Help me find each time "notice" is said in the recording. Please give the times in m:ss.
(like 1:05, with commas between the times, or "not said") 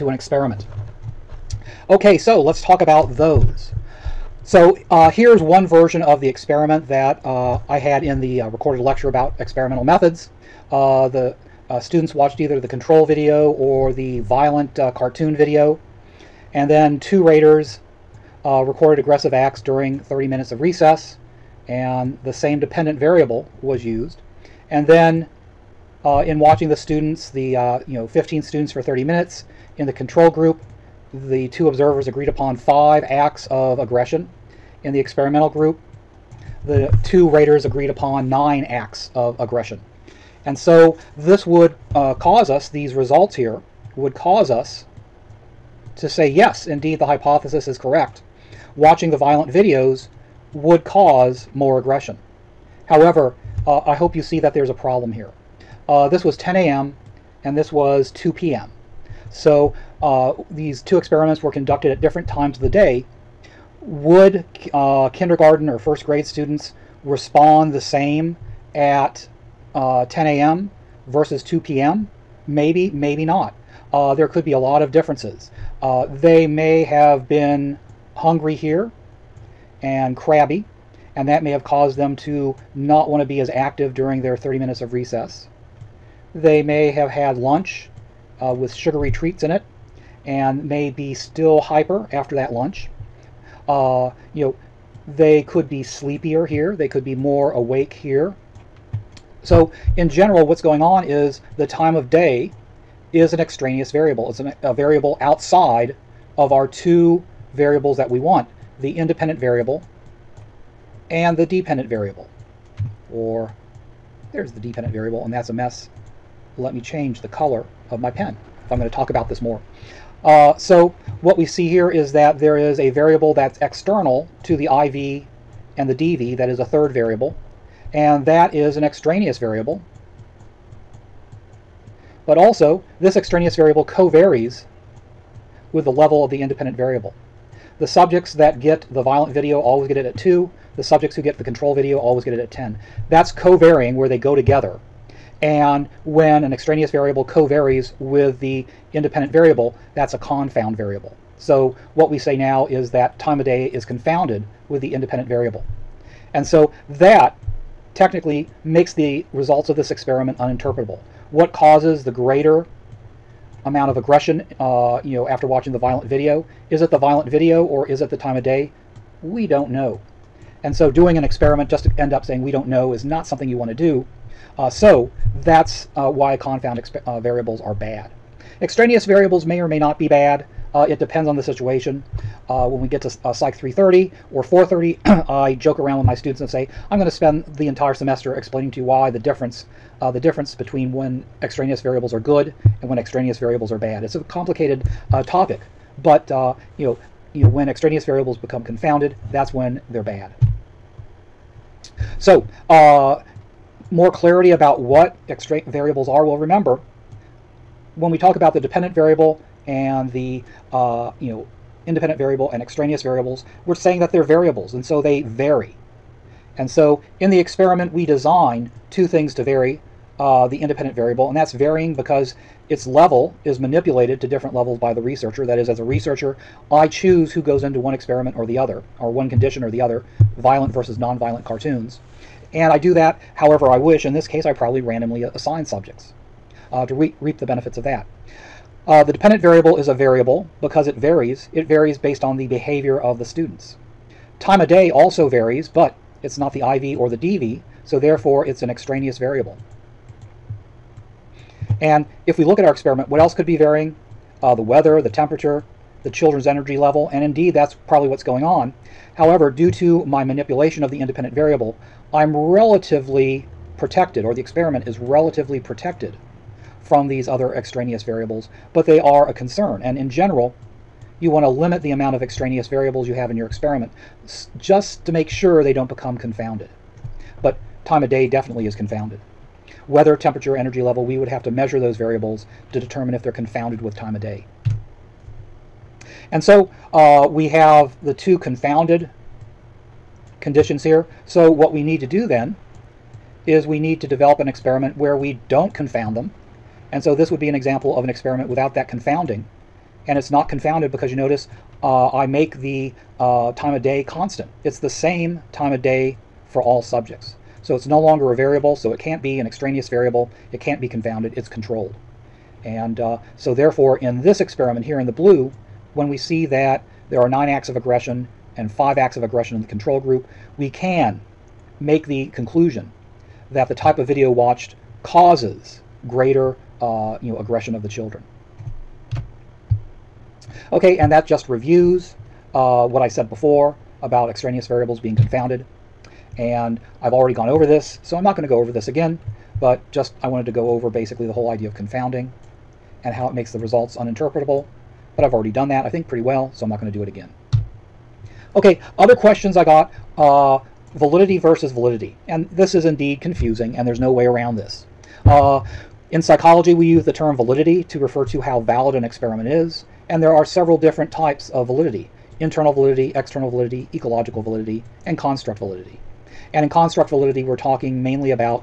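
5:01.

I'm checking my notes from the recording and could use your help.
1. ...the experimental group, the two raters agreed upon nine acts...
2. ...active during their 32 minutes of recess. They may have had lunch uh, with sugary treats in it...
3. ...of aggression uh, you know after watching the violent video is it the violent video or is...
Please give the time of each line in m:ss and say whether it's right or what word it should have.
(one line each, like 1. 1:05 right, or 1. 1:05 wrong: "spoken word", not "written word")
1. 0:34 right
2. 1:23 wrong: "30", not "32"
3. 2:43 right.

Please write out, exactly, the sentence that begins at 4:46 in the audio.
And so uh, we have the two confounded conditions here.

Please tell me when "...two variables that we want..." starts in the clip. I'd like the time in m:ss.
1:46.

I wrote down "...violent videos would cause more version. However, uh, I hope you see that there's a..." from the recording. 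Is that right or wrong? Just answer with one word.
wrong.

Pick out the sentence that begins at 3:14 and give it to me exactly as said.
It's a complicated uh, topic, but uh, you know you know, when extraneous variables become confounded, that's when they're bad.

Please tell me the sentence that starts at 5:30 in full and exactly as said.
Okay, and that just reviews uh, what I said before about extraneous variables being confounded.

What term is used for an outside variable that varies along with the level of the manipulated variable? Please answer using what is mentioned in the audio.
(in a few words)
confound variable.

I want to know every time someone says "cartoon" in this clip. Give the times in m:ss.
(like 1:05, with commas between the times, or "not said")
0:14, 3:51.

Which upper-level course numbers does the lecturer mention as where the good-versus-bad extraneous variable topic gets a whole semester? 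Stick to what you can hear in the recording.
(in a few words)
Psych 330 or 430.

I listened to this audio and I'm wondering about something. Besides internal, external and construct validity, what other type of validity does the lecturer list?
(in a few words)
ecological validity.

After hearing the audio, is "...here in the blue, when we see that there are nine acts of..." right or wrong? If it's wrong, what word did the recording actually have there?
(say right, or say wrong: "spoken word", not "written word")
right.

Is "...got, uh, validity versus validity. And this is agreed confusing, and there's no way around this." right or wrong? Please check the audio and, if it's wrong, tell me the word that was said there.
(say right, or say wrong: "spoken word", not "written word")
wrong: "indeed", not "agreed".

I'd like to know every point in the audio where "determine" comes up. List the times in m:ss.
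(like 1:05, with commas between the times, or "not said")
4:42.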